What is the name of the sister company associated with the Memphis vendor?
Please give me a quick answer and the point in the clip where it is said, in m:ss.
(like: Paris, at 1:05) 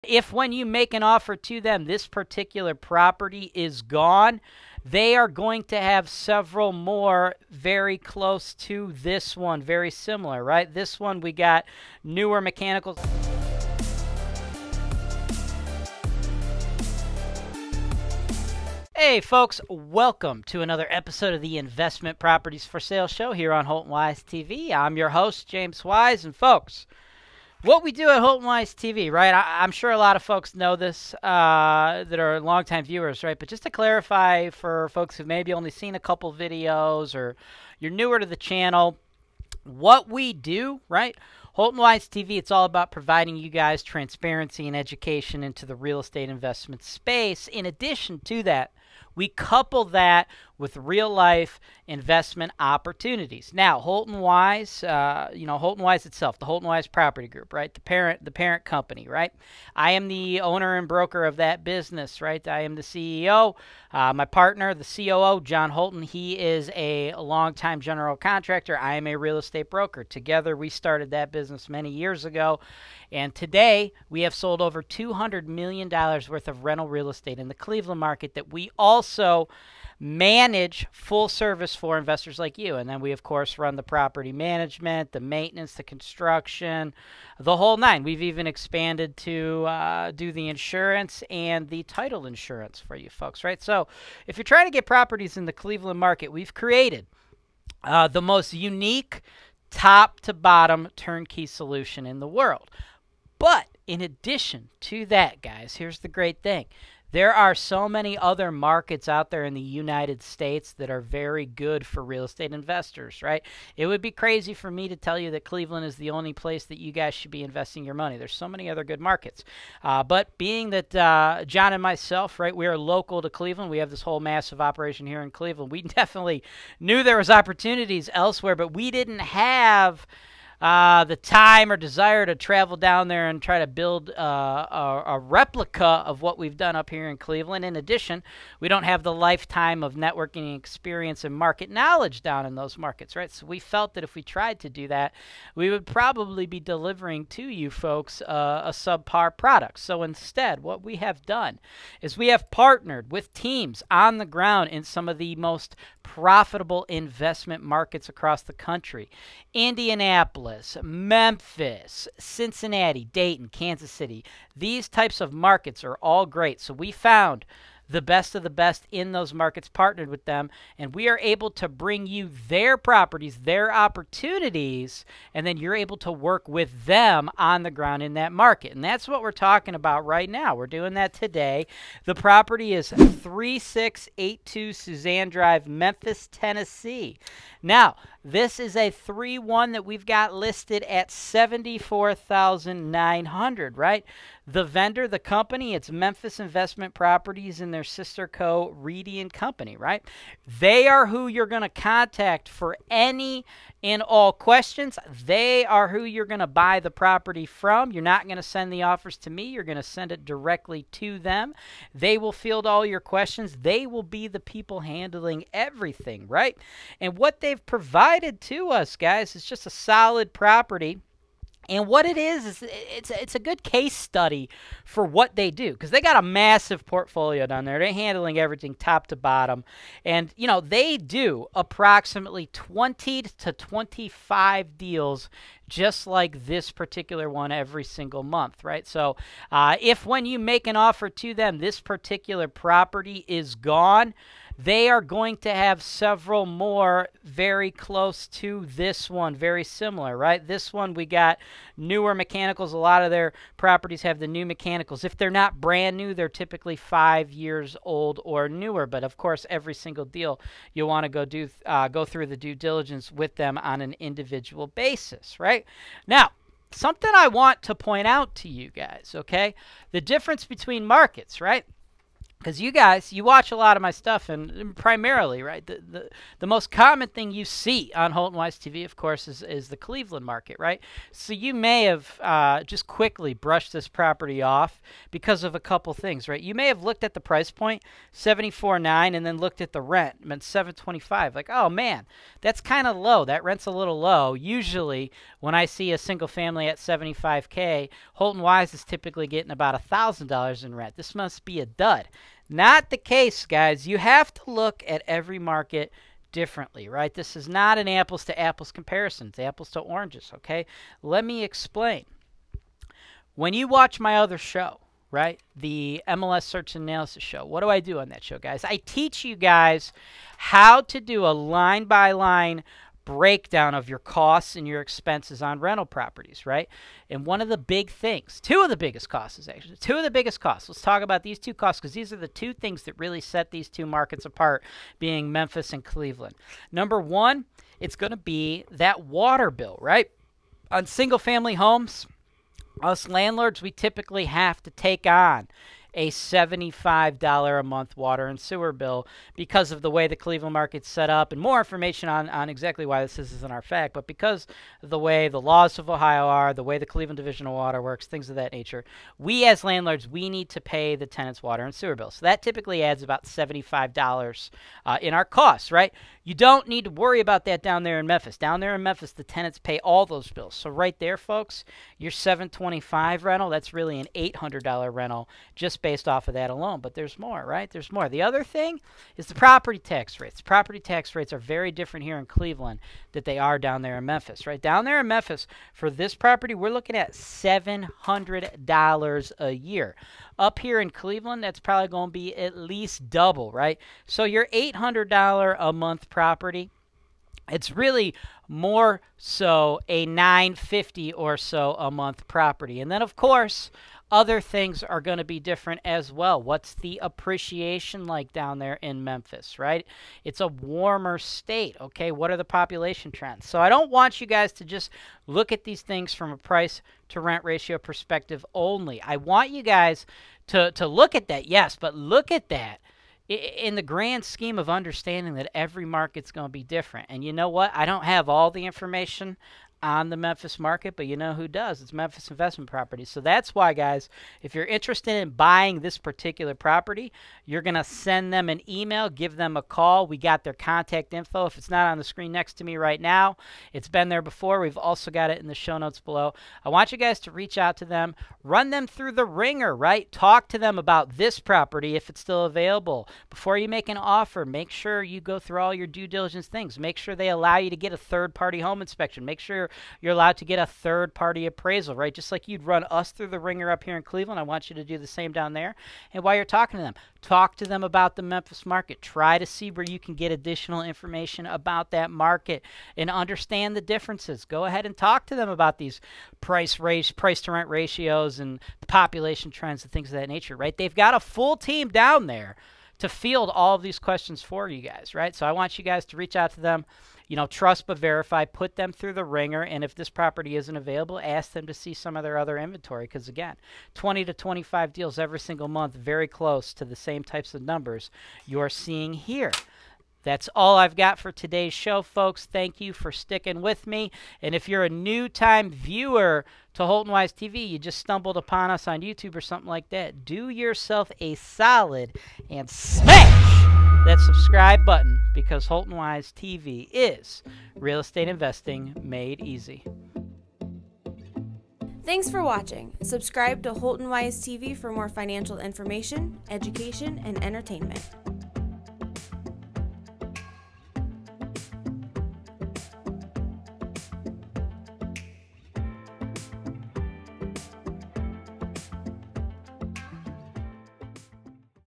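Reedy and Company, at 3:18.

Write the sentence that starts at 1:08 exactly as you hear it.
I am a real estate broker.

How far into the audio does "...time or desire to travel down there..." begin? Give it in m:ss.
2:11.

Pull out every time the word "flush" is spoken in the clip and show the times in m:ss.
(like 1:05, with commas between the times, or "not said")
not said.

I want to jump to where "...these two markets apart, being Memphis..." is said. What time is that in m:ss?
5:33.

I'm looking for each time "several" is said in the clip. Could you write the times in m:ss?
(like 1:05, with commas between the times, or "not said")
0:06, 4:05.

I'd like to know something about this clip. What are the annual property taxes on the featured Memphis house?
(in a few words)
$700.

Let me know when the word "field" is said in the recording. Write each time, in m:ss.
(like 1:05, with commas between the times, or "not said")
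3:32, 8:03.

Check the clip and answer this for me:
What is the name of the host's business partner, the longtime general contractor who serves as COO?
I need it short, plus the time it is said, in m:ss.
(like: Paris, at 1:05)
John Holton, at 1:05.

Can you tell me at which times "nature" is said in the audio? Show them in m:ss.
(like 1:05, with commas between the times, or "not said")
5:58, 8:00.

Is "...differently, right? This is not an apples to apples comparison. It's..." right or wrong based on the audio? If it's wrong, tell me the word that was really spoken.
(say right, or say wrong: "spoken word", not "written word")
right.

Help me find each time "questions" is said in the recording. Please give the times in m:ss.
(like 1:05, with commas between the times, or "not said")
3:24, 3:32, 8:03.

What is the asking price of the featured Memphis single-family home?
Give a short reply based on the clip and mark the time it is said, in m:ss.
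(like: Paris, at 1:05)
74900, at 3:11.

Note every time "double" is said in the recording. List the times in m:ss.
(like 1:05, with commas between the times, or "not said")
6:33.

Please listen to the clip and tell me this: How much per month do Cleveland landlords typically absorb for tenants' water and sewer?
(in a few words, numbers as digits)
$75.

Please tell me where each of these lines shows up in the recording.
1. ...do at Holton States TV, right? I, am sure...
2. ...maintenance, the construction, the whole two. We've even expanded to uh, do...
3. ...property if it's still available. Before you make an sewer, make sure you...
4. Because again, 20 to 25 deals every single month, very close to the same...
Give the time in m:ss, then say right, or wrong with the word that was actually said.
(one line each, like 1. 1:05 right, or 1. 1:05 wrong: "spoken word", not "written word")
1. 0:27 wrong: "Wise", not "States"
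2. 1:25 wrong: "nine", not "two"
3. 7:31 wrong: "offer", not "sewer"
4. 8:13 right.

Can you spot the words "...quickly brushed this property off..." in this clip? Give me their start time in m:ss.
4:42.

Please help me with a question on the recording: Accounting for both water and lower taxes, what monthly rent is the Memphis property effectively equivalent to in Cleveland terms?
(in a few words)
950.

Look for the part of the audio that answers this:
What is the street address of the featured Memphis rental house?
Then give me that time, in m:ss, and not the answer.
3:02.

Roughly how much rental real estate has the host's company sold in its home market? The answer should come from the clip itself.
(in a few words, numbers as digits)
$200 million.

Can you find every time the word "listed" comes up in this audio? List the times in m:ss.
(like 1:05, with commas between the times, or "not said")
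3:10.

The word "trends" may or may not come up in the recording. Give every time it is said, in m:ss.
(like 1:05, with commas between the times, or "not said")
6:53, 7:59.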